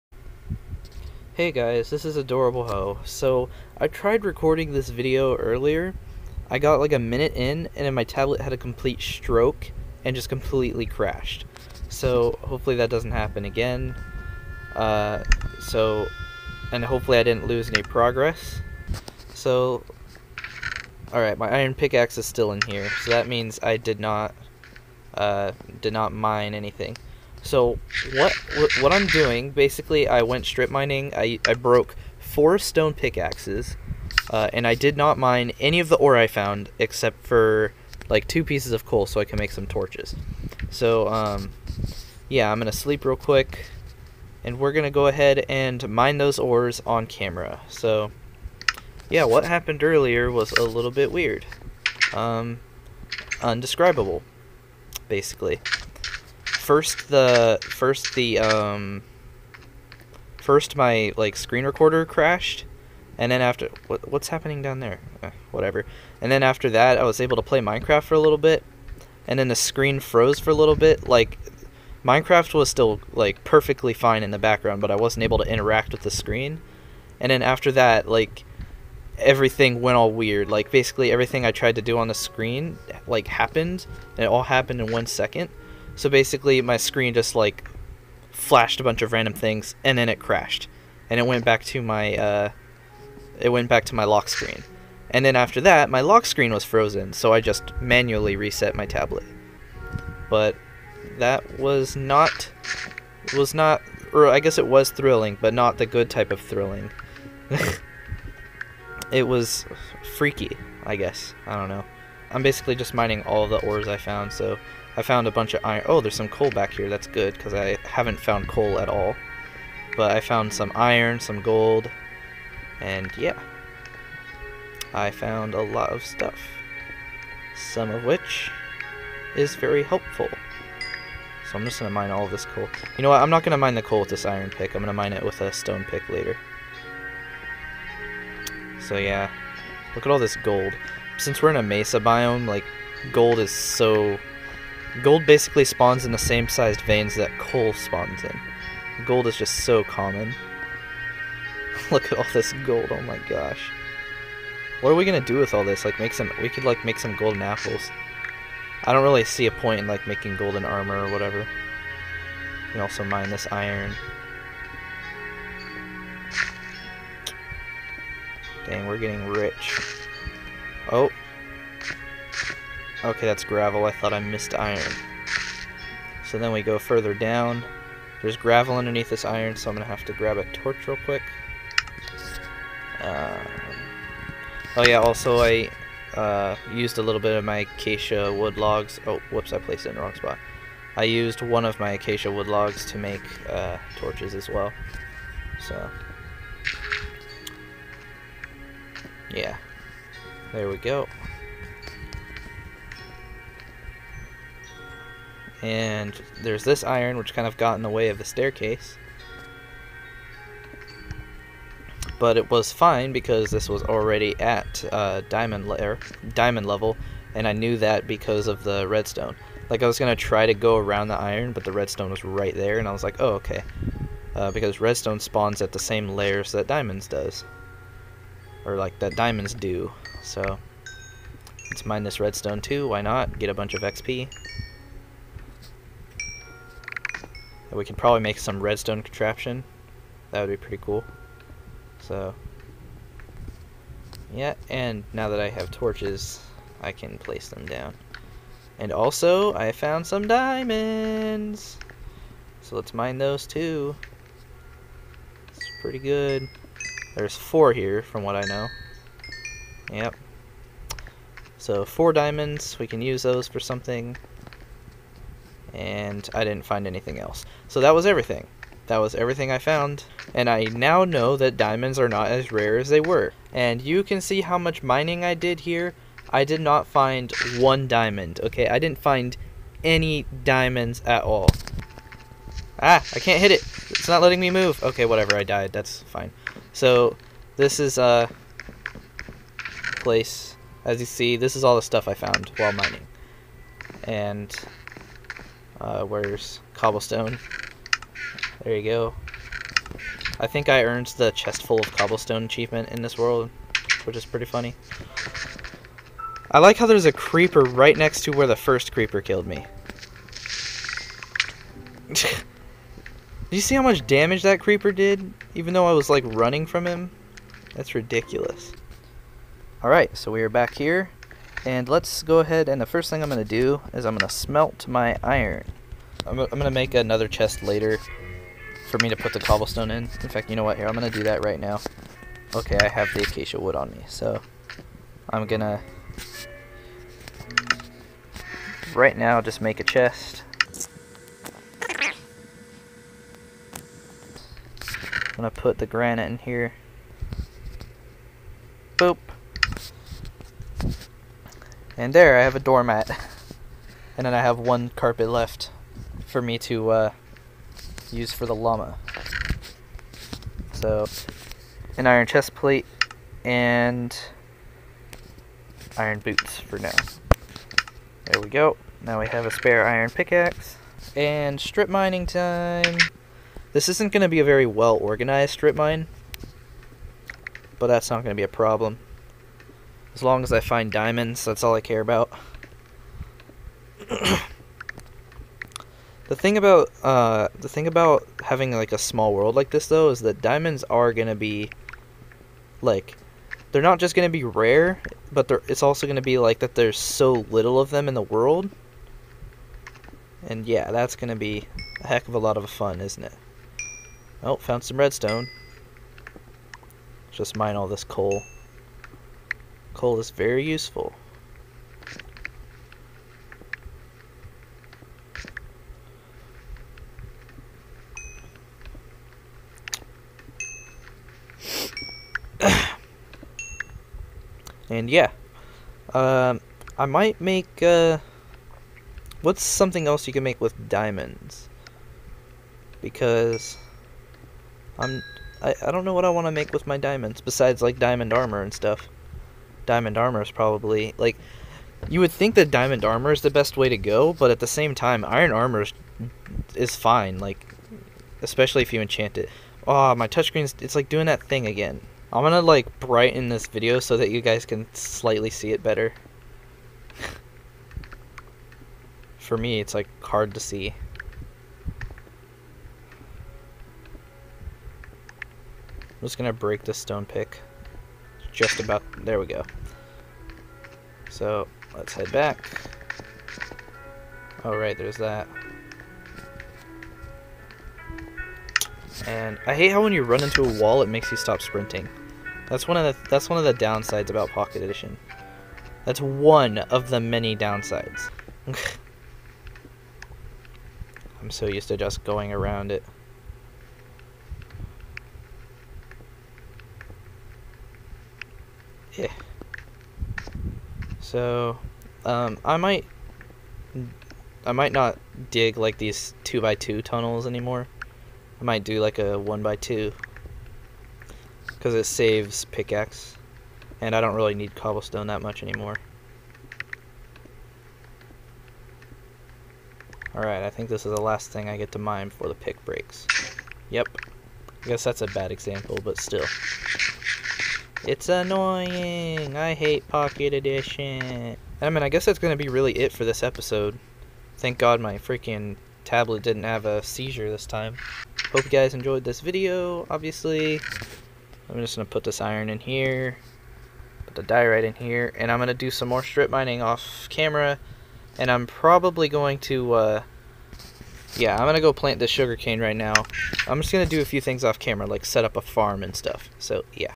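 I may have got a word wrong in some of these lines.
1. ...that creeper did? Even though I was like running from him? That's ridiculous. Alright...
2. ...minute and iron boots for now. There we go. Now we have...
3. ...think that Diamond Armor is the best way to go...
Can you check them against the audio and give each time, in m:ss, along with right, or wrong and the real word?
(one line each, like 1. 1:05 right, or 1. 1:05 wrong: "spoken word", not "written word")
1. 5:14 right
2. 6:02 wrong: "plate", not "minute"
3. 7:22 right.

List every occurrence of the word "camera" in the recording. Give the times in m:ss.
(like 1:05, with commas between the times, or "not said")
0:47, 9:07, 9:14.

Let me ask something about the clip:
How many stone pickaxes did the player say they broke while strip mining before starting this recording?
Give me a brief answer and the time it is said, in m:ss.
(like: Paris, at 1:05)
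4, at 0:32.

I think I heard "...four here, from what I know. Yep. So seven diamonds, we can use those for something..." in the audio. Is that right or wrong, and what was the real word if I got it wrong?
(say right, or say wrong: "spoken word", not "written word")
wrong: "four", not "seven".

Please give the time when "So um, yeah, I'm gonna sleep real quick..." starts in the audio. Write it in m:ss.
0:40.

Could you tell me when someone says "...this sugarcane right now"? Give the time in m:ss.
9:12.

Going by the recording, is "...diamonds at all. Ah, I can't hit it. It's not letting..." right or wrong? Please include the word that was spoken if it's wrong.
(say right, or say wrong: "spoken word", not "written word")
right.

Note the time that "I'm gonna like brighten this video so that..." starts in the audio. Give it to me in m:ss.
7:32.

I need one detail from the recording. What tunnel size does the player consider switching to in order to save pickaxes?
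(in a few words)
One by two.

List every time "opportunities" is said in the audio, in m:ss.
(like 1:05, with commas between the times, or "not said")
not said.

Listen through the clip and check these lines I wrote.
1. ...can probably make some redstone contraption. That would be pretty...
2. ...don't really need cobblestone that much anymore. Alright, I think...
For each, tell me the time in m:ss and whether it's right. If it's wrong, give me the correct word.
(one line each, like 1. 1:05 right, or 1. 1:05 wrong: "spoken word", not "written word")
1. 3:57 right
2. 8:34 right.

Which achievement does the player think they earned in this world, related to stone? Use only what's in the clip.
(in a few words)
Chest full of cobblestone.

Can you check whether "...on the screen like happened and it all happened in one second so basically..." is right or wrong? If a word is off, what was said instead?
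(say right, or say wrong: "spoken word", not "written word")
right.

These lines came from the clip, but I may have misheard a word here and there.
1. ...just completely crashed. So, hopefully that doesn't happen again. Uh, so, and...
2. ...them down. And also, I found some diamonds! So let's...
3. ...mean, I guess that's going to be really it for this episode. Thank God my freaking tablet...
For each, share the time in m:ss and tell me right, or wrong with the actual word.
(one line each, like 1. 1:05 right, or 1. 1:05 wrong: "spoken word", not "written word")
1. 0:10 right
2. 4:07 right
3. 8:51 right.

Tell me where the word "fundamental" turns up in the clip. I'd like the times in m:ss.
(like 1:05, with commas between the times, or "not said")
not said.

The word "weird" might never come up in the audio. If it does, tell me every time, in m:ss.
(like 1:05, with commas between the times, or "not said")
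0:51, 1:20.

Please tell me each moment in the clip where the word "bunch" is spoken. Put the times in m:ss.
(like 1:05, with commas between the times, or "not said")
1:28, 1:55, 3:53.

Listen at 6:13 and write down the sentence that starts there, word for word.
This isn't going to be a very well organized strip mine, but that's not going to be a problem.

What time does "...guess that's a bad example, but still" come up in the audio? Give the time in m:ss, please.
8:44.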